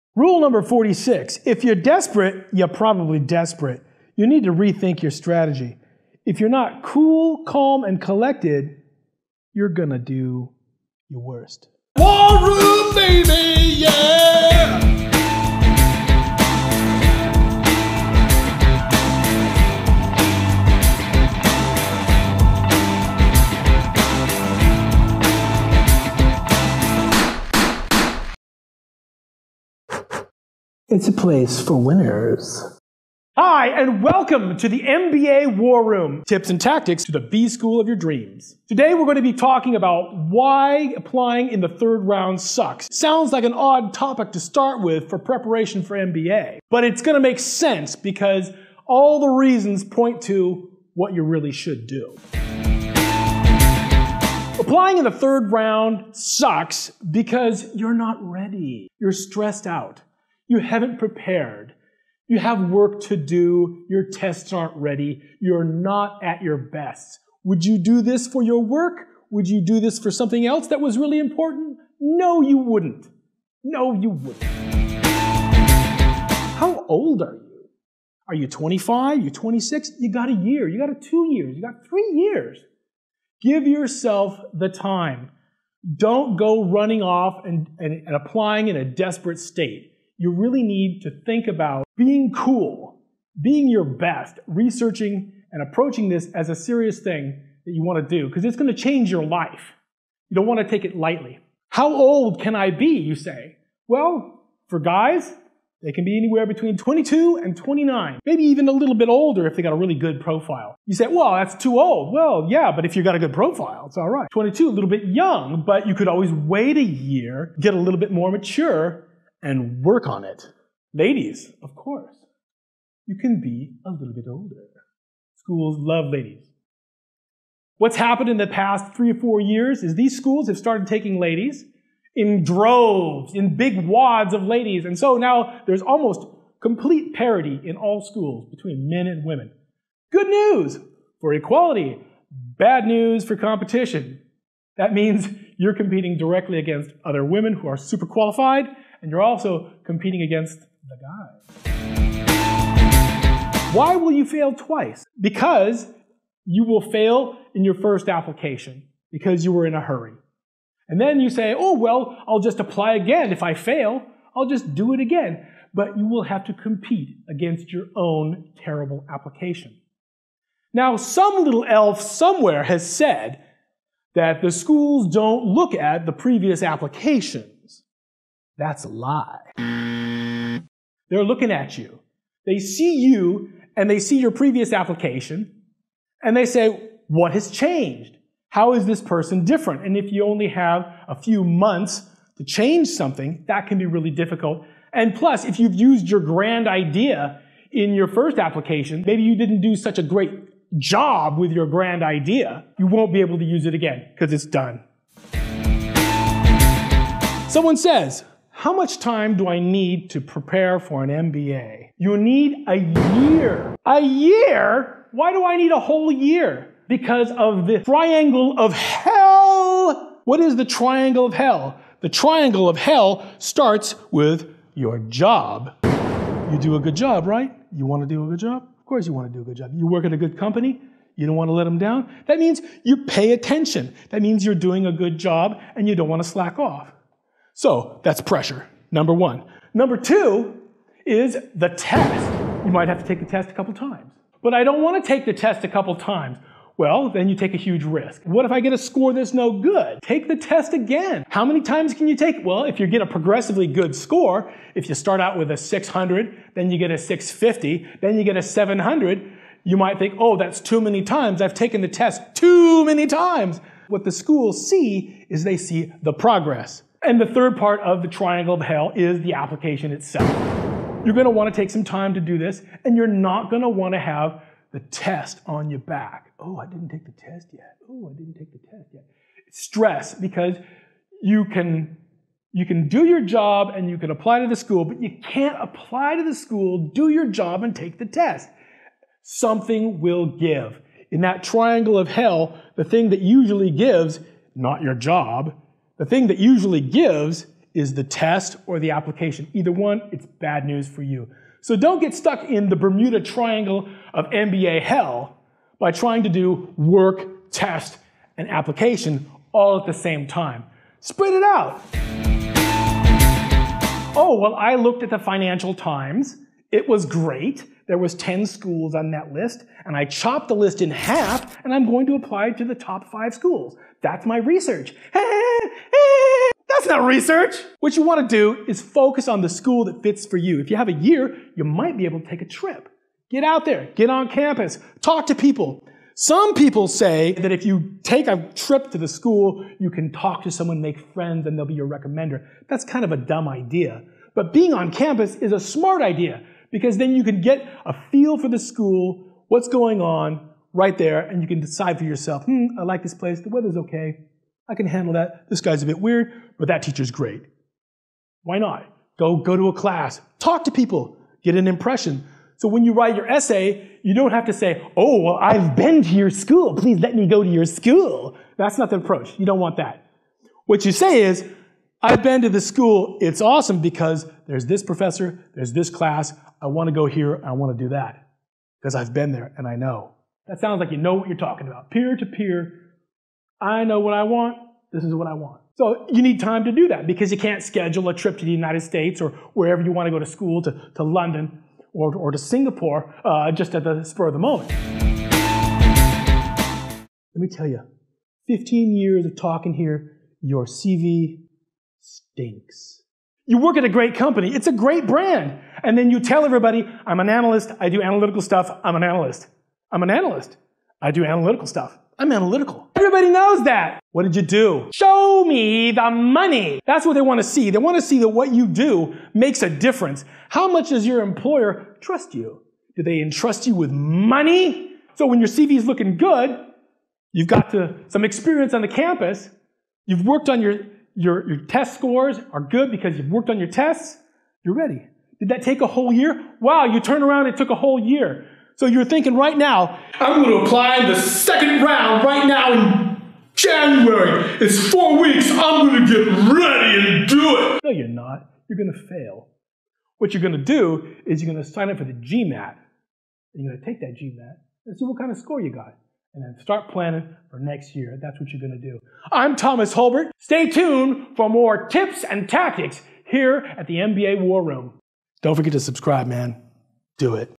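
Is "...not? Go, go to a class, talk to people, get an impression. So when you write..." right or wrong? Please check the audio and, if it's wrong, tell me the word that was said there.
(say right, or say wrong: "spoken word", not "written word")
right.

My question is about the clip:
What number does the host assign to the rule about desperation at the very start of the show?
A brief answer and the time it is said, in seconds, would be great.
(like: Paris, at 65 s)
46, at 0 s.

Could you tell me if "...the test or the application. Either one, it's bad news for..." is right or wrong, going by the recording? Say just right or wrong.
right.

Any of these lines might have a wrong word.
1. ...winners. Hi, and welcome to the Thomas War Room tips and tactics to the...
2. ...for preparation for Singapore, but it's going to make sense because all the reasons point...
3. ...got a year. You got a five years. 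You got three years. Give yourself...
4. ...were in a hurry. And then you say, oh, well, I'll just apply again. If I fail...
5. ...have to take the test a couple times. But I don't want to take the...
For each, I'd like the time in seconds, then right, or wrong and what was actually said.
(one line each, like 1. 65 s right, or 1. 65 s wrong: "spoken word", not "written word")
1. 31 s wrong: "MBA", not "Thomas"
2. 45 s wrong: "MBA", not "Singapore"
3. 80 s wrong: "two", not "five"
4. 159 s right
5. 242 s right.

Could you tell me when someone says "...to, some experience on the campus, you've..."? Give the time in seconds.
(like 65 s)
427 s.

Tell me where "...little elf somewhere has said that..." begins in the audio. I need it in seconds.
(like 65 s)
171 s.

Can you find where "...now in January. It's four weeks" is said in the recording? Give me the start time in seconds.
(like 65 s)
442 s.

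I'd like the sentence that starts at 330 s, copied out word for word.
If you have a year, you might be able to take a trip.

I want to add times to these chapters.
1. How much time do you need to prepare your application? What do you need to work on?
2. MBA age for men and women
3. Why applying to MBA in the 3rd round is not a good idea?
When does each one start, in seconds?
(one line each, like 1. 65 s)
1. 205 s
2. 105 s
3. 40 s.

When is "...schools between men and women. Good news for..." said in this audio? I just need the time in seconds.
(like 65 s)
138 s.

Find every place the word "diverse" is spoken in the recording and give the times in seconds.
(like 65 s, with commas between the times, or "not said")
not said.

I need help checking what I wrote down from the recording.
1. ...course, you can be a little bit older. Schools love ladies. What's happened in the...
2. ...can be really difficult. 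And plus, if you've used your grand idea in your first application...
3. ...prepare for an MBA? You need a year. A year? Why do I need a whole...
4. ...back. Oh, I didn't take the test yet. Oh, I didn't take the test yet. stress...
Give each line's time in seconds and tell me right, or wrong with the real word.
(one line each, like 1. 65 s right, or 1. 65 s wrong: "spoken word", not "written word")
1. 121 s right
2. 193 s right
3. 210 s right
4. 275 s right.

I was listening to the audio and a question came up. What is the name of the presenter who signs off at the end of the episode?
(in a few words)
Thomas Hulbert.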